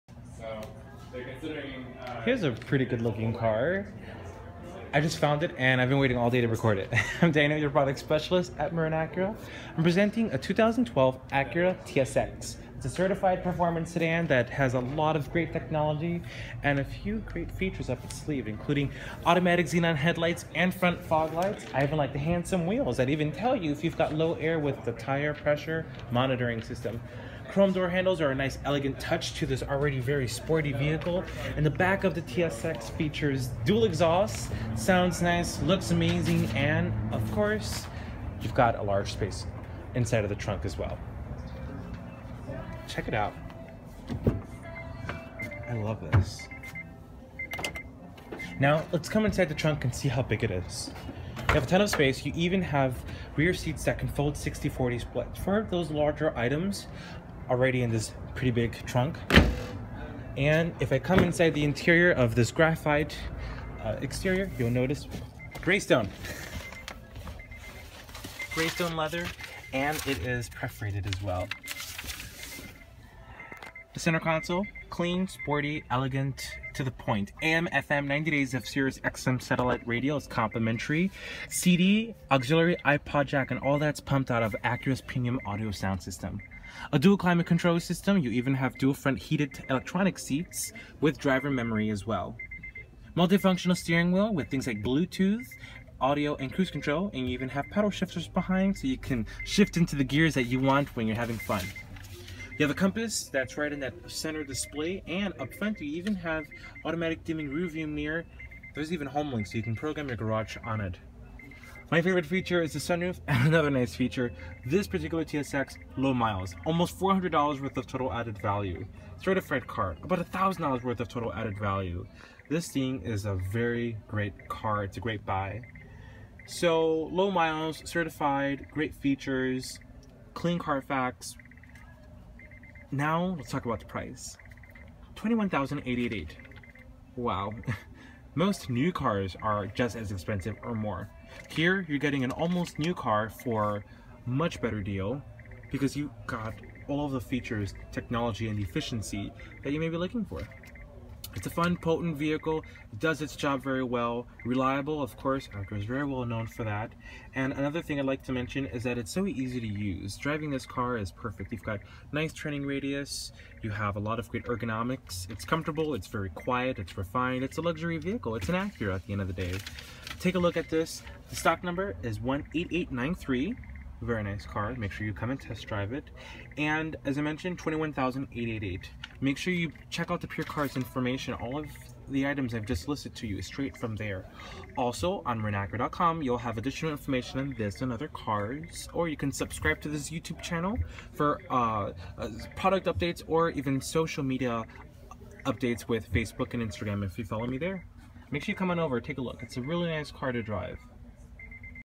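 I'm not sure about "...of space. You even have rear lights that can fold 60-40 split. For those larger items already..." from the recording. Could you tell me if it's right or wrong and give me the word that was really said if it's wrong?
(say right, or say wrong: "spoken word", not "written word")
wrong: "seats", not "lights".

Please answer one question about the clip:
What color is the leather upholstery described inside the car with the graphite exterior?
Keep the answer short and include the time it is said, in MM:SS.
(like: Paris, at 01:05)
Graystone, at 01:08.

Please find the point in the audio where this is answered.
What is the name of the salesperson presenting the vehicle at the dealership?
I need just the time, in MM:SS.
00:07.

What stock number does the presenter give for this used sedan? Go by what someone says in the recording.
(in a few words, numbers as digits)
18893.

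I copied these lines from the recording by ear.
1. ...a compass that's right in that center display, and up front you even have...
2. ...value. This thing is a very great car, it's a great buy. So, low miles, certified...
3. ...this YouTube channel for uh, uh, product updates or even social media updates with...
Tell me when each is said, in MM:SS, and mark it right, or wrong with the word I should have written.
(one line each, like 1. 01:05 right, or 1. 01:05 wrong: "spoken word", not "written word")
1. 01:42 right
2. 02:01 right
3. 03:09 right.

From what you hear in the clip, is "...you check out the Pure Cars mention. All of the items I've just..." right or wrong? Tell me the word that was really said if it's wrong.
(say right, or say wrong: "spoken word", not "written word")
wrong: "information", not "mention".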